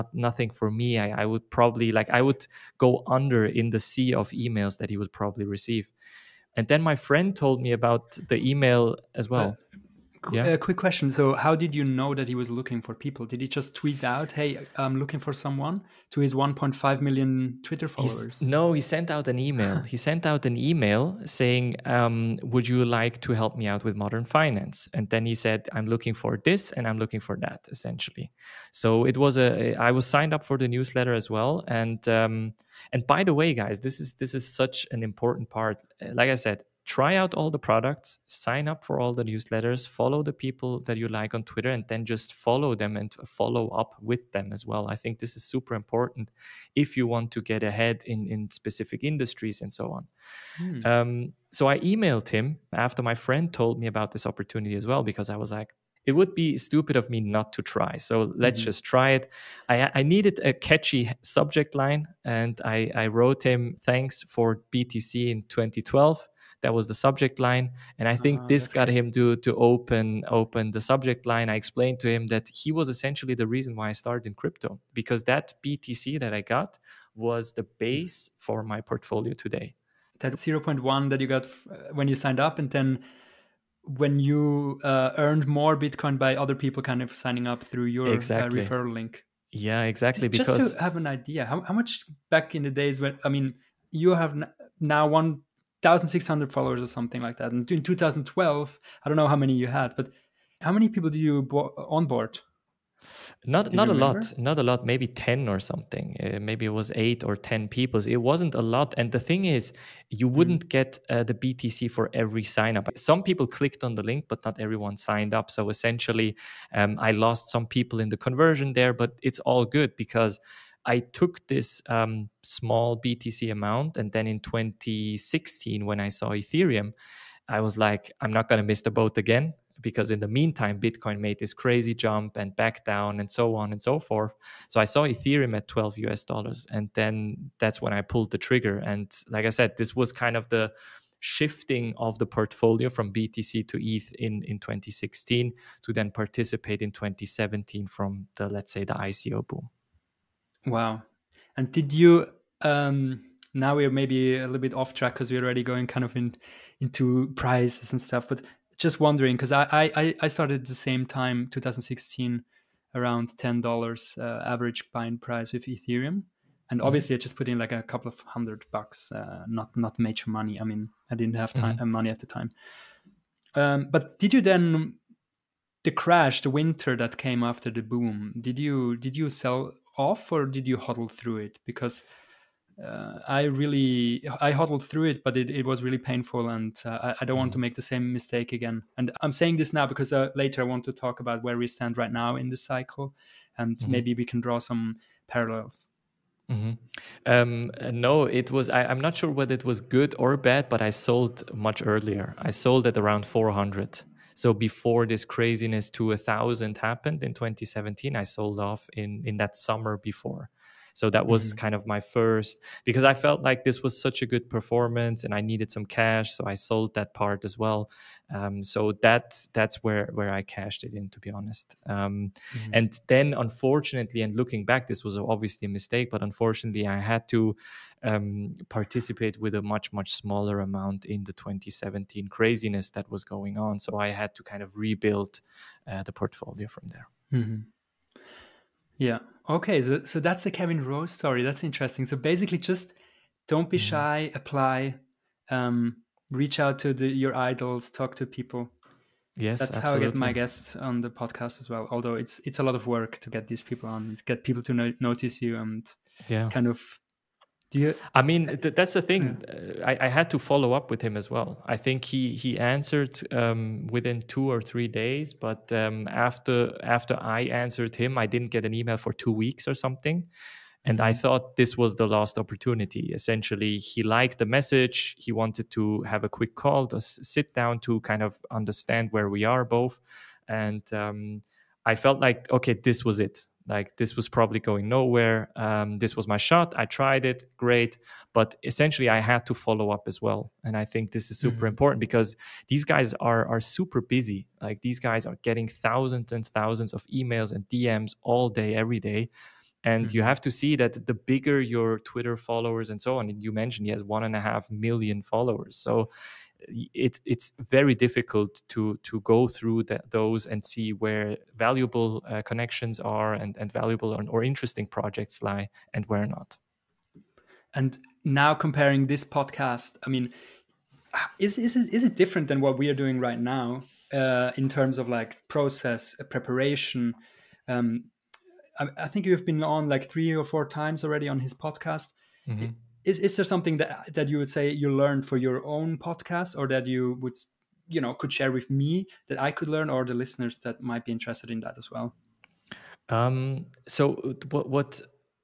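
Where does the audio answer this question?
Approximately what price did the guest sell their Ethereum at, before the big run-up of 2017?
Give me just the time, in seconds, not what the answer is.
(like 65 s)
203 s.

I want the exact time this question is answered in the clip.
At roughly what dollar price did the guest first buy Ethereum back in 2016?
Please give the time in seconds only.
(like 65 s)
135 s.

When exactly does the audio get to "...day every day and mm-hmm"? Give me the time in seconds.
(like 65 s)
298 s.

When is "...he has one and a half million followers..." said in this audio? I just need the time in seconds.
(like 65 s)
303 s.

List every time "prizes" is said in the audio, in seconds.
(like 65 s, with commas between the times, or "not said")
157 s.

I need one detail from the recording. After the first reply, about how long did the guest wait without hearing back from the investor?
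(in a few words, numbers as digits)
2 weeks.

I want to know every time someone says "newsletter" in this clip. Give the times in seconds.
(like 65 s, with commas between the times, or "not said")
30 s, 39 s.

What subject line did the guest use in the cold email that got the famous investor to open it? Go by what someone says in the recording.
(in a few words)
Thanks for BTC in 2012.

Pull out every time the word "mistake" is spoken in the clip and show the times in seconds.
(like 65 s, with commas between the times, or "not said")
188 s, 225 s.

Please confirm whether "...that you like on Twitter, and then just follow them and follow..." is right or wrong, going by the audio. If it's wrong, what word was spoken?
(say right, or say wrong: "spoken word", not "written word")
right.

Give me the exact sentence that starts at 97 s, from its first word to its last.
And in 2012, I don't know how many you had, but how many people do you bo- onboard?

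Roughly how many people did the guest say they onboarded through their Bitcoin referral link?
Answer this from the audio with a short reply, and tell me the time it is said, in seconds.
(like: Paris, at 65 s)
8 or 10, at 106 s.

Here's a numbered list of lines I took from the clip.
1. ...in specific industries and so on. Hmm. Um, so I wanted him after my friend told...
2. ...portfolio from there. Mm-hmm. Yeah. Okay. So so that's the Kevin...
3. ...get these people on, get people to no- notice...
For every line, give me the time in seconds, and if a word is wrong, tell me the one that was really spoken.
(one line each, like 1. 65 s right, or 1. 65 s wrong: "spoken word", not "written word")
1. 48 s wrong: "emailed", not "wanted"
2. 236 s right
3. 253 s right.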